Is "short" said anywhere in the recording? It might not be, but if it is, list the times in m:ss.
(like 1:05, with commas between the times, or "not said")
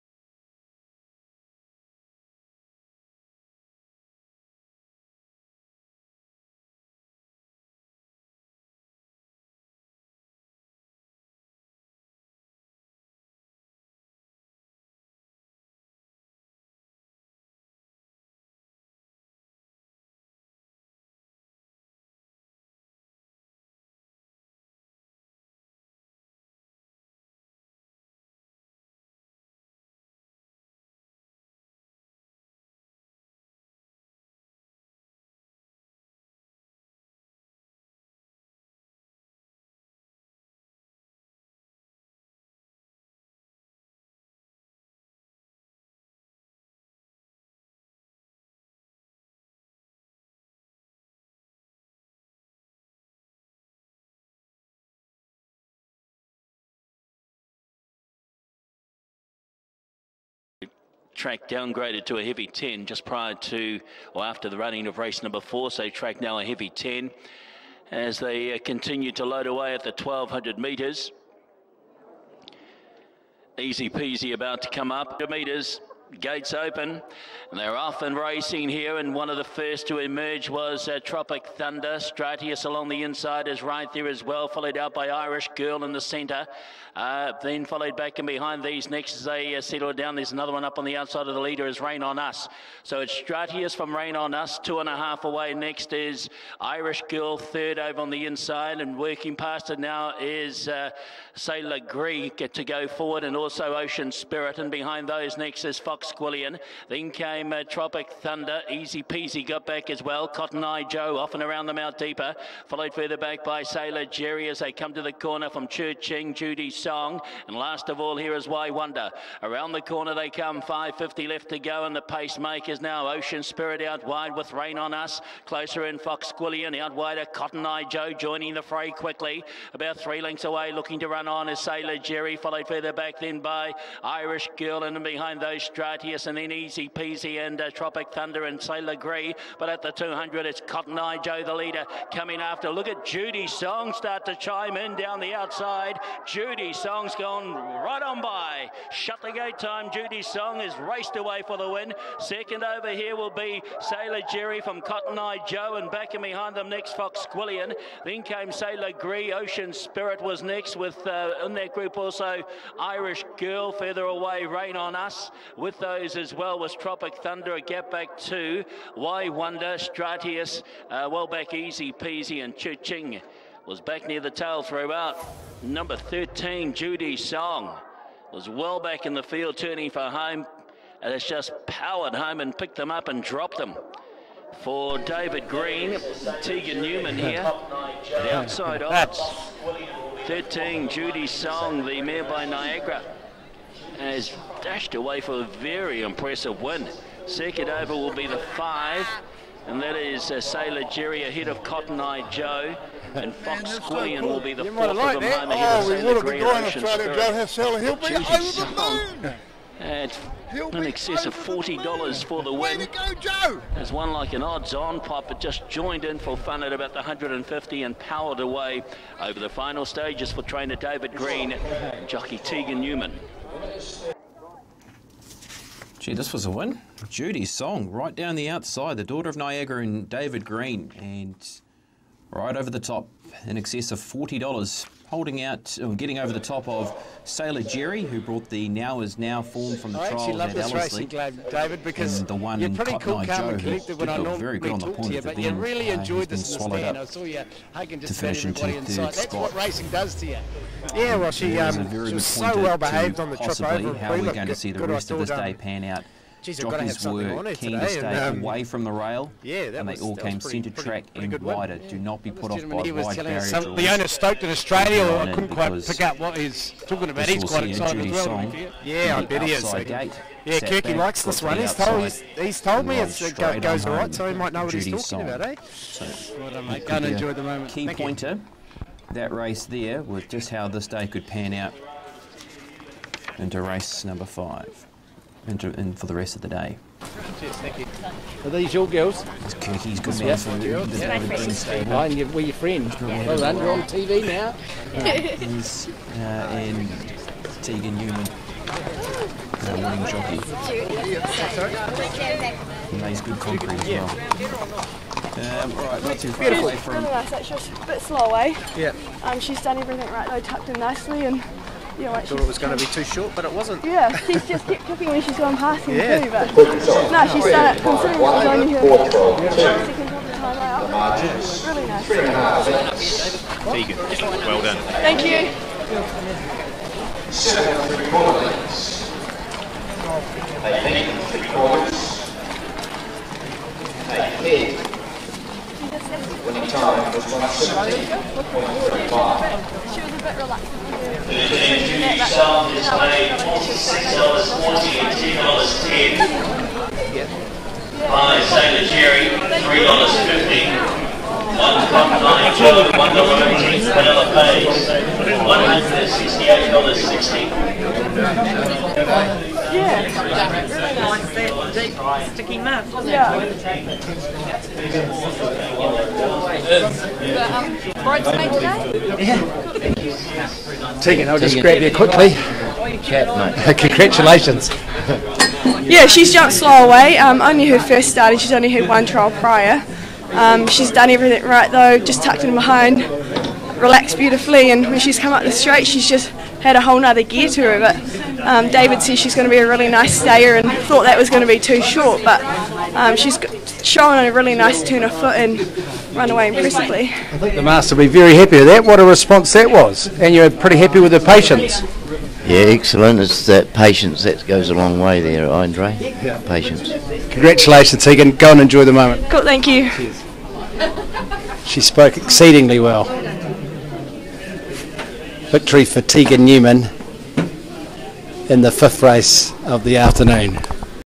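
5:13, 6:31.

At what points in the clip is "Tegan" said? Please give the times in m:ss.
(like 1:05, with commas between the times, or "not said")
3:06, 3:42, 4:57, 6:10, 6:48, 6:56.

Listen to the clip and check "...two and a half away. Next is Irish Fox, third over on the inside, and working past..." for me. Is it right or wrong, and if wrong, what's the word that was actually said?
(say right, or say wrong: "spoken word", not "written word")
wrong: "Girl", not "Fox".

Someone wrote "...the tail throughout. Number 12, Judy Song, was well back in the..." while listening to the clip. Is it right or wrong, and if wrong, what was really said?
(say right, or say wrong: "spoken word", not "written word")
wrong: "13", not "12".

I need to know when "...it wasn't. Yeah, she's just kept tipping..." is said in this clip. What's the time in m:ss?
5:13.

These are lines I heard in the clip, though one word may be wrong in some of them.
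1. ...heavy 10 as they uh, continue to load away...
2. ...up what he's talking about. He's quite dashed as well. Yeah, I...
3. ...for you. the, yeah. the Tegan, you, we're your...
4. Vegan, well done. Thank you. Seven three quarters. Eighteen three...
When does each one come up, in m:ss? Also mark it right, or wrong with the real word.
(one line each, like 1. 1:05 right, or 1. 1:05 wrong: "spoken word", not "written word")
1. 1:06 right
2. 4:26 wrong: "excited", not "dashed"
3. 4:50 wrong: "Mine", not "Tegan"
4. 5:23 right.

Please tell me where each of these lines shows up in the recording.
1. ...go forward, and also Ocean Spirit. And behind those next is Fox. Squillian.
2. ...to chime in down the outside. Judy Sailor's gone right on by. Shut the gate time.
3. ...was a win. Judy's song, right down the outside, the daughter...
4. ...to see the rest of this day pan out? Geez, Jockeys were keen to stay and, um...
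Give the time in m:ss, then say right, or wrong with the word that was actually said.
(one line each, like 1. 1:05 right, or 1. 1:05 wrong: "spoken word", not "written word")
1. 1:42 right
2. 2:24 wrong: "Song", not "Sailor"
3. 3:46 right
4. 4:14 right.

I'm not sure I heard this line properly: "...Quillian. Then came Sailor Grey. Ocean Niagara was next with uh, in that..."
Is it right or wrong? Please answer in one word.
wrong.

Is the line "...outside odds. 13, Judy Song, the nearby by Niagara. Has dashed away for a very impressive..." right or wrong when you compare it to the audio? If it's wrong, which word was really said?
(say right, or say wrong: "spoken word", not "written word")
right.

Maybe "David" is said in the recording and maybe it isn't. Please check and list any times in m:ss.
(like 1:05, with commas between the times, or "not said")
3:04, 3:40, 3:50, 4:01, 6:28.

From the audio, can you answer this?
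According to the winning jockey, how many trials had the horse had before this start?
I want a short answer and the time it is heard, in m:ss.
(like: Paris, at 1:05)
1, at 6:18.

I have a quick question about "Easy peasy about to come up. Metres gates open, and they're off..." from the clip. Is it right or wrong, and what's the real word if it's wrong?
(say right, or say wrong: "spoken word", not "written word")
right.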